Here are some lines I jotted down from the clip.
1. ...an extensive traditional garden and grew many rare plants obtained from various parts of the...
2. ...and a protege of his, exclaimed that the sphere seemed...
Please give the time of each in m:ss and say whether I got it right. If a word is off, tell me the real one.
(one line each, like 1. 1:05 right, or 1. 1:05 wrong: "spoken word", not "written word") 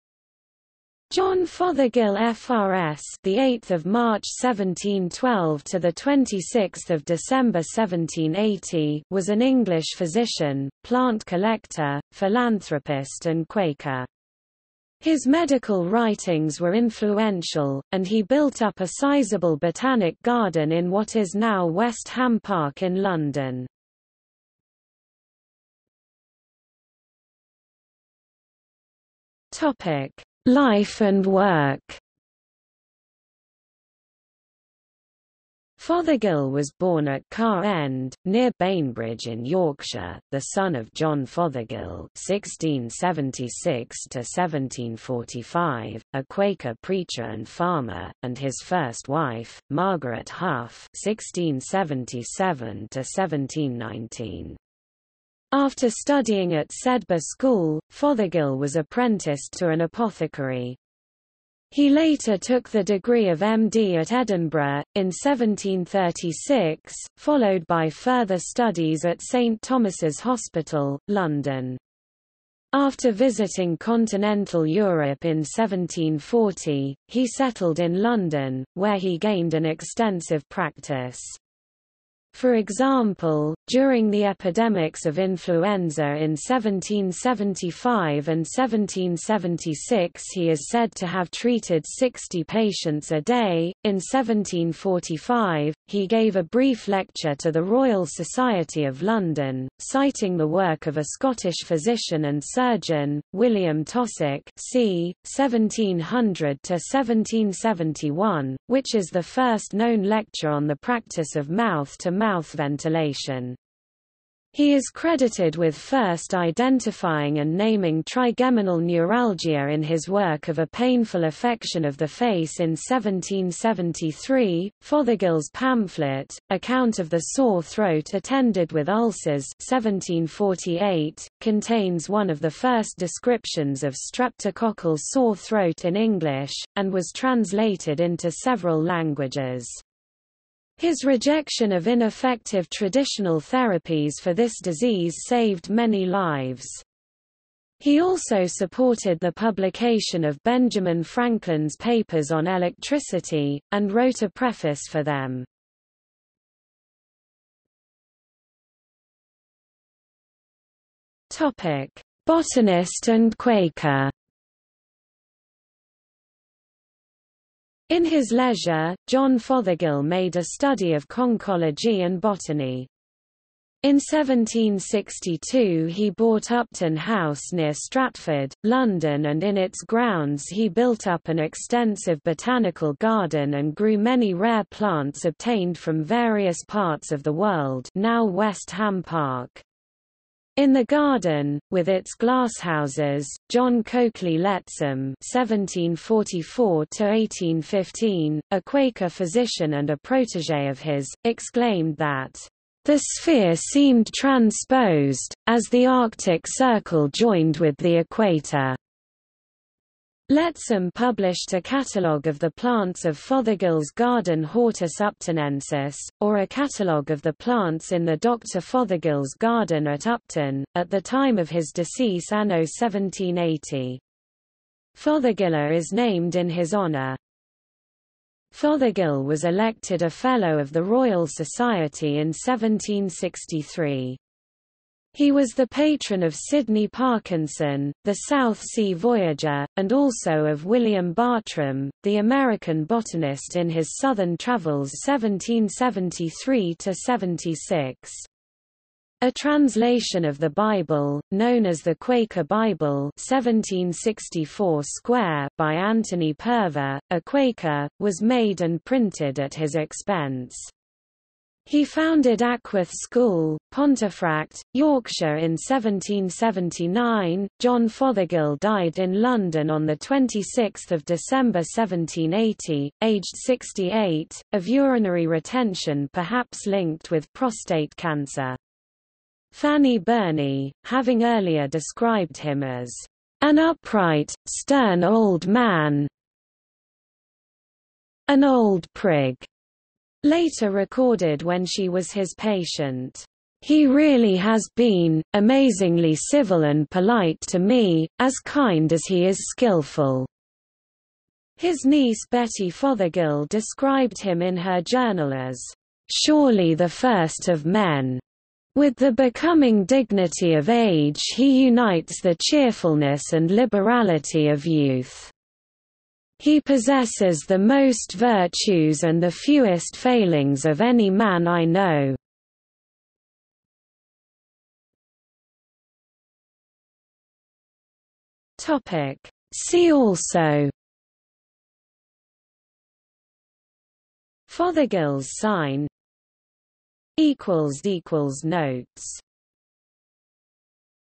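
1. 3:01 wrong: "botanical", not "traditional"
2. 3:19 right.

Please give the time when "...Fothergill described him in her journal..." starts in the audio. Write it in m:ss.
5:02.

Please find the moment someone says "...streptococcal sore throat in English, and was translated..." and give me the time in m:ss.
2:13.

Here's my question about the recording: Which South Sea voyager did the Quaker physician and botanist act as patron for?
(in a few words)
Sydney Parkinson.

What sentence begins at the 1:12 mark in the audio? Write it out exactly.
After visiting continental Europe in 1740, he settled in London, where he gained an extensive practice.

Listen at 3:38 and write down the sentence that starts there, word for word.
Fothergill's garden at Upton, at the time of his decease anno 1780.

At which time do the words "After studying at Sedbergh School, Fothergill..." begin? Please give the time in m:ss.
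0:55.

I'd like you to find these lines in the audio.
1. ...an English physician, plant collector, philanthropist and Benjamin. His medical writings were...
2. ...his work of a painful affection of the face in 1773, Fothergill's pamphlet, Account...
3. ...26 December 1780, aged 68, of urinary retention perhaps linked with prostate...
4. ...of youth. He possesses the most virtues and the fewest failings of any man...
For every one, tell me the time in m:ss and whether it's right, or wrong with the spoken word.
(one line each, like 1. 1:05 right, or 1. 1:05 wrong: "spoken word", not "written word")
1. 0:09 wrong: "Quaker", not "Benjamin"
2. 1:59 right
3. 4:29 right
4. 5:14 right.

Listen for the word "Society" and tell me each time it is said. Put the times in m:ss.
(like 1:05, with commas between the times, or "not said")
1:38, 3:51.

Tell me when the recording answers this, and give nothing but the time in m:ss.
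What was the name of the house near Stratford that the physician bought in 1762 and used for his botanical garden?
2:56.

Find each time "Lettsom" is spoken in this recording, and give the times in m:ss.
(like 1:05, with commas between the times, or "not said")
3:14, 3:30.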